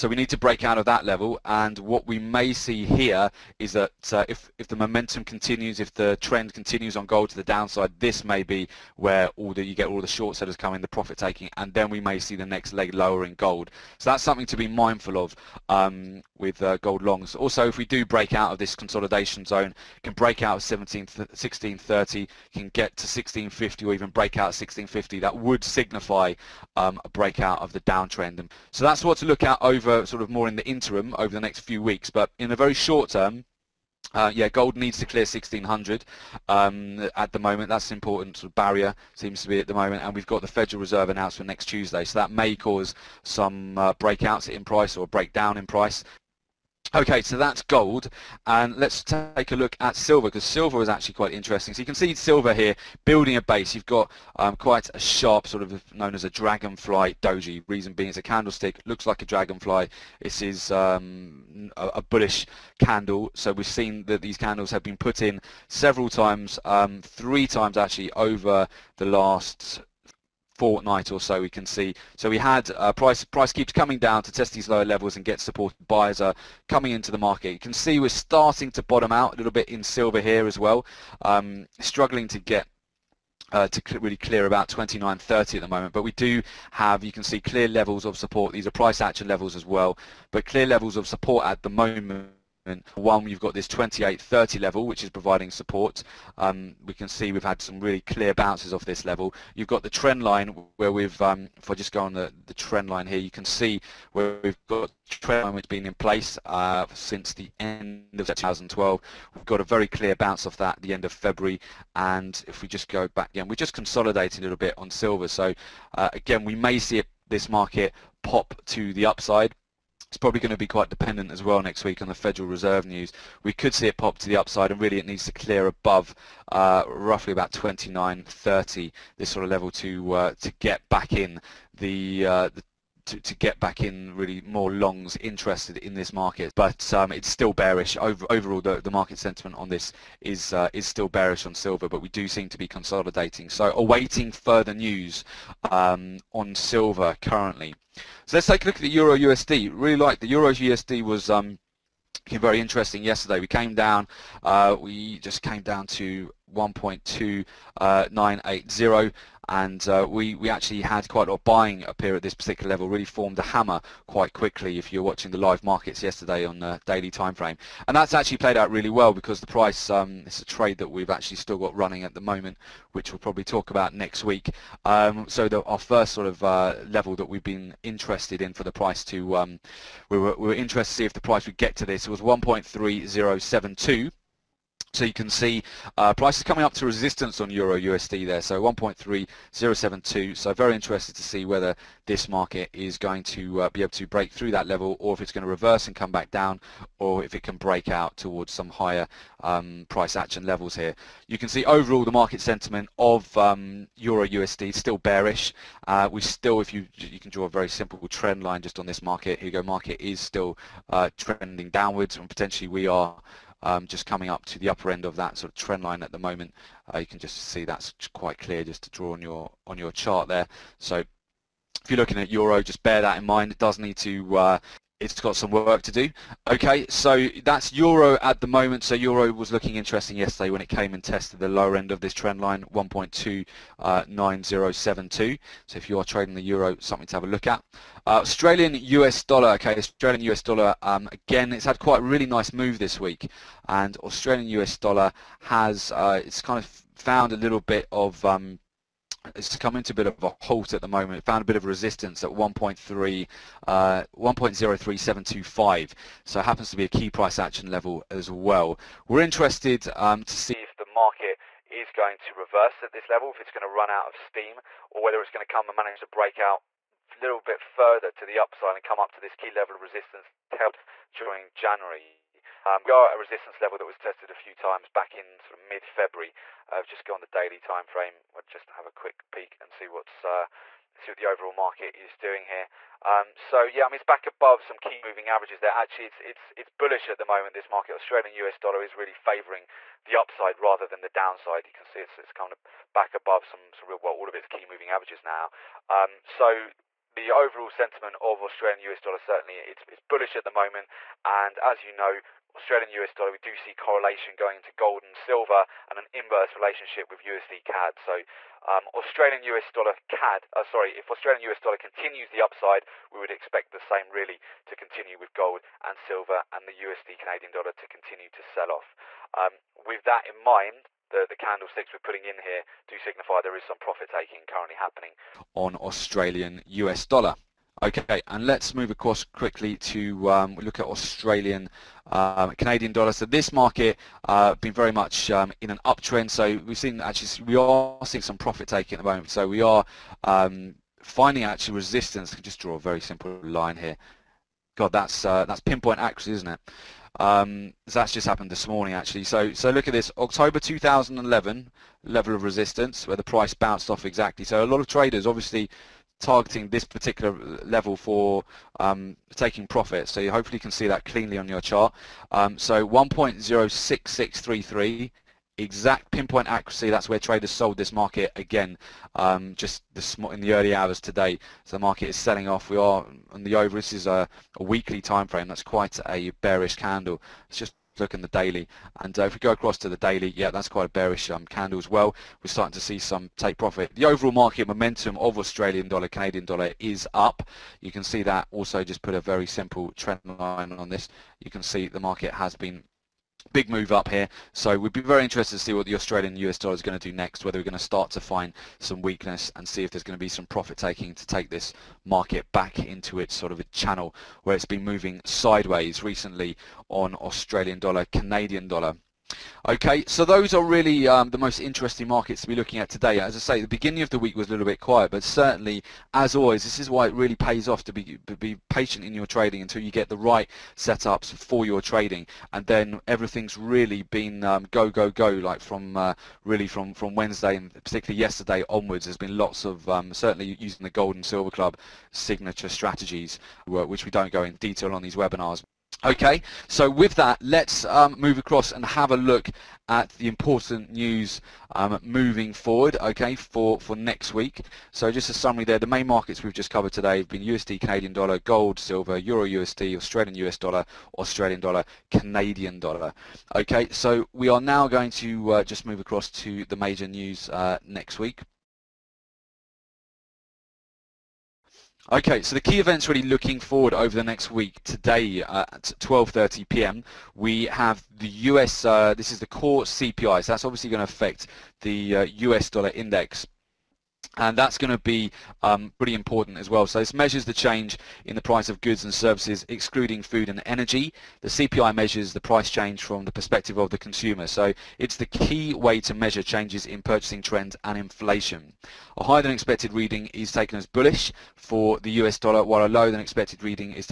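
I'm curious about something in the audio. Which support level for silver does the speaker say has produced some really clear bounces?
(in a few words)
28.30.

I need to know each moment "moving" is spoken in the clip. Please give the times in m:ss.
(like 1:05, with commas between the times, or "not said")
4:45, 4:54, 6:44, 7:22.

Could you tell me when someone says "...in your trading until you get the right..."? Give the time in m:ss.
6:59.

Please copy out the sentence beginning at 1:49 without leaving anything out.
We've got a very clear bounce off that at the end of February.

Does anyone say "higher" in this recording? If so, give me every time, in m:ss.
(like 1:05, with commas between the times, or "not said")
3:18, 8:09.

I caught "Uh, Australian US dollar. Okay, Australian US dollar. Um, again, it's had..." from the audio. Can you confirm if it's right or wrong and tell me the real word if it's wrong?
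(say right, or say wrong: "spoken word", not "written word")
right.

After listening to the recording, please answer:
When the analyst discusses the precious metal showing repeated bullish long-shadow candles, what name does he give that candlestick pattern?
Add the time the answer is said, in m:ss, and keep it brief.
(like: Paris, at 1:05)
dragonfly doji, at 0:56.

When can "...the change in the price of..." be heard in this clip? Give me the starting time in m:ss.
7:57.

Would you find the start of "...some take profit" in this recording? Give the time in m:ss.
6:22.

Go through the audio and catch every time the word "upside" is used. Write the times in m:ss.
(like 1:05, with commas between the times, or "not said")
1:59, 2:04, 4:28, 4:50, 5:12.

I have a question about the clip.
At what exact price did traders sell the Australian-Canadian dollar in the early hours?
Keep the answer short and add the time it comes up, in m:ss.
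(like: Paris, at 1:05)
1.06633, at 6:02.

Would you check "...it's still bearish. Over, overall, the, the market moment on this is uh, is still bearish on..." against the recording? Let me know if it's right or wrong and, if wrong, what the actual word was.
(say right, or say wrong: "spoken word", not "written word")
wrong: "sentiment", not "moment".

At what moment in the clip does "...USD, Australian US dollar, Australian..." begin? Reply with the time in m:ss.
7:29.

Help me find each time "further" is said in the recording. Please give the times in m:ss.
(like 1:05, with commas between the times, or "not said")
2:24, 4:27.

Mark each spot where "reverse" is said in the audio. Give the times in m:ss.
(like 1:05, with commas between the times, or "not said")
3:15, 4:22.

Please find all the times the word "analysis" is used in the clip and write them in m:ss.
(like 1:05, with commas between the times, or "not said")
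not said.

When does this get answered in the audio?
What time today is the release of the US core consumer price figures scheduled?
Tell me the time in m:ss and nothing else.
7:46.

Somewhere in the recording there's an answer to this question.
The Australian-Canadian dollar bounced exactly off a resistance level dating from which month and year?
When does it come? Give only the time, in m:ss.
5:50.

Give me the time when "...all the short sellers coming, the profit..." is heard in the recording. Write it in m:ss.
0:09.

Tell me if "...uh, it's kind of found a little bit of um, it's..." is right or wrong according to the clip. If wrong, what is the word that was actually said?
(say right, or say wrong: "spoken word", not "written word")
right.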